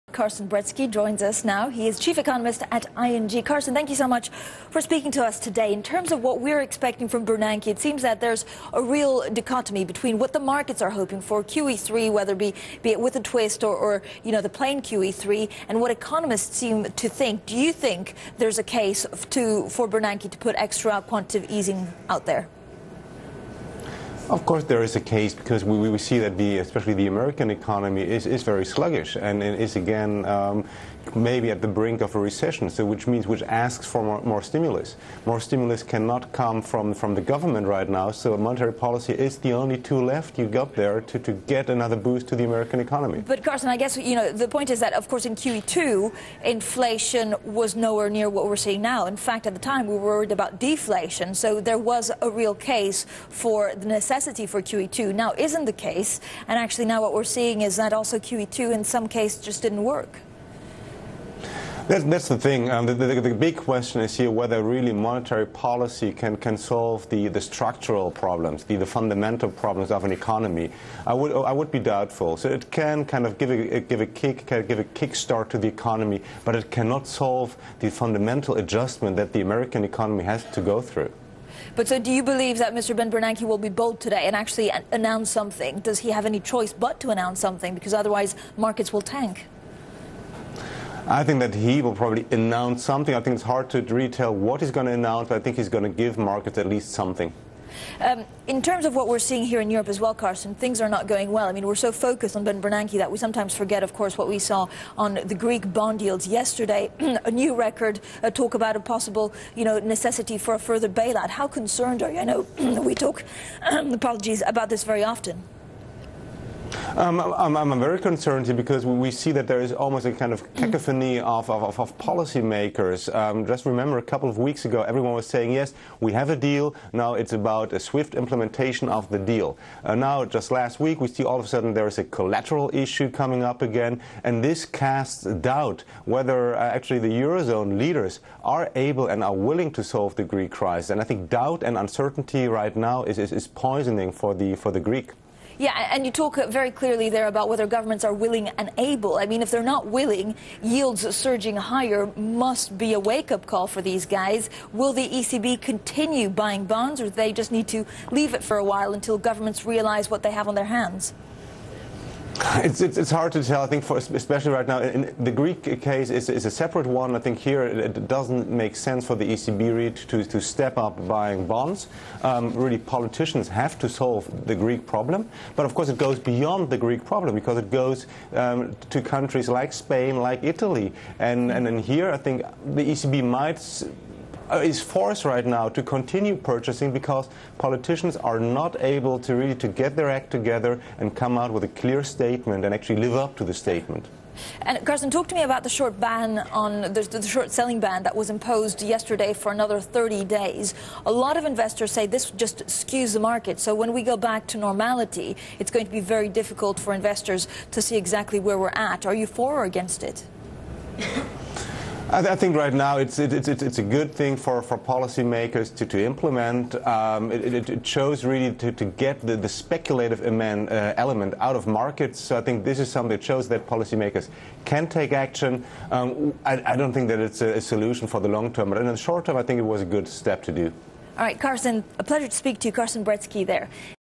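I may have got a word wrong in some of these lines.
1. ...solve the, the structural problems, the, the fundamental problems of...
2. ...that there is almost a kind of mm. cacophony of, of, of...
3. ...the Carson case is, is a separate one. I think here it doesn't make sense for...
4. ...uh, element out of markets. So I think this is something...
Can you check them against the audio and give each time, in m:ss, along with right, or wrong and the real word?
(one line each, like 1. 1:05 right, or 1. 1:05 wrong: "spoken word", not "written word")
1. 1:06 right
2. 1:59 right
3. 2:45 wrong: "Greek", not "Carson"
4. 3:40 right.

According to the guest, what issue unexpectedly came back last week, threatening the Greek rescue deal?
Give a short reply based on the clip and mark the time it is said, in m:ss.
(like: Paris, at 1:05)
collateral issue, at 2:12.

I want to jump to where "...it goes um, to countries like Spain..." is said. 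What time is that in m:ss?
2:57.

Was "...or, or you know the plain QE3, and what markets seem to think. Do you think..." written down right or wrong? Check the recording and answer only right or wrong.
wrong.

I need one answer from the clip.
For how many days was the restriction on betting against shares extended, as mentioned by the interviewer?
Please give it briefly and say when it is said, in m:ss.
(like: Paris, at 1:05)
30, at 3:19.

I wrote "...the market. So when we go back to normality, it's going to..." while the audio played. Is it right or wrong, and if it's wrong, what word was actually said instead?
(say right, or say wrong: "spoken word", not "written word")
right.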